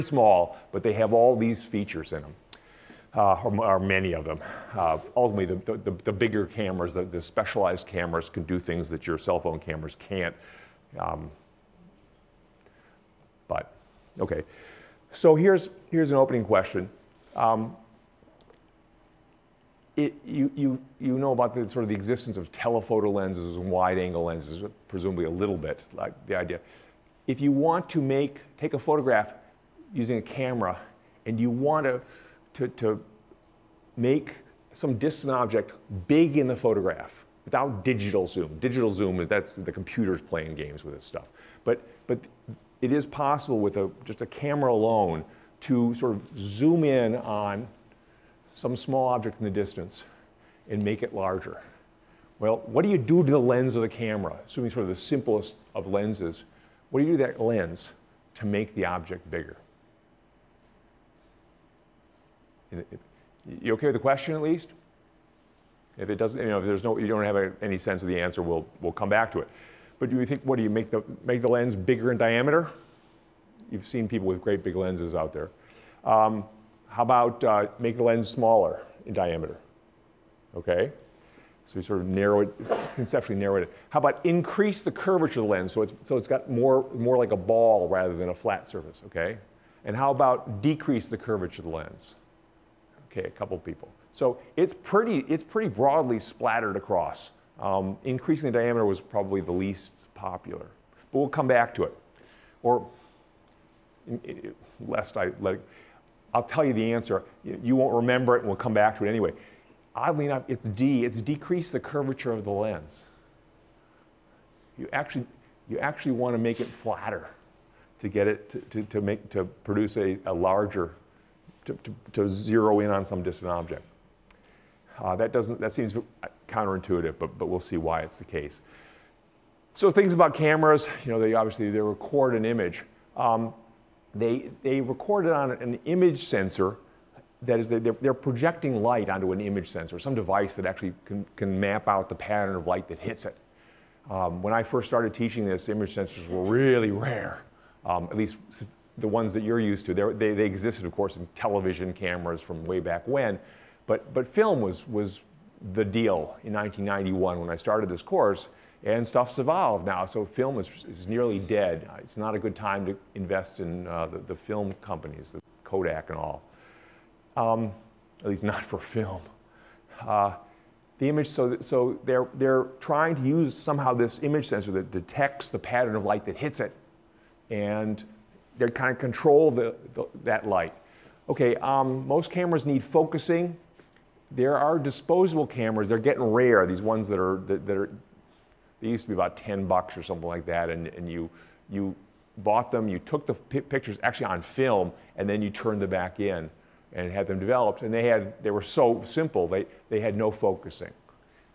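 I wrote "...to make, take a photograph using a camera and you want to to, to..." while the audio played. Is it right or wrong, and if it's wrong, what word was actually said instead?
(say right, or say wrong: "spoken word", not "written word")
right.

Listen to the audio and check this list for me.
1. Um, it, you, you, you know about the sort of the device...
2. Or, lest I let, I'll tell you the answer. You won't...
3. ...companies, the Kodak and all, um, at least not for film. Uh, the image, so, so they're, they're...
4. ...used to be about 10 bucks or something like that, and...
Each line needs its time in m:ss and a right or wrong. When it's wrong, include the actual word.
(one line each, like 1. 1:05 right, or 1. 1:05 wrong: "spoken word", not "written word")
1. 0:17 wrong: "existence", not "device"
2. 1:42 right
3. 2:44 right
4. 3:08 right.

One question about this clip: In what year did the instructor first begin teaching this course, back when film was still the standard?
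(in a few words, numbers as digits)
1991.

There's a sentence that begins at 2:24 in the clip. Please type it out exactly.
Um, when I first started teaching this, image sensors were really rare, um, at least the ones that you're used to.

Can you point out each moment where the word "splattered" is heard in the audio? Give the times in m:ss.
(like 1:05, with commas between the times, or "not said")
1:36.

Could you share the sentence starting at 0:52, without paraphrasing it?
Well, what do you do to the lens of the camera?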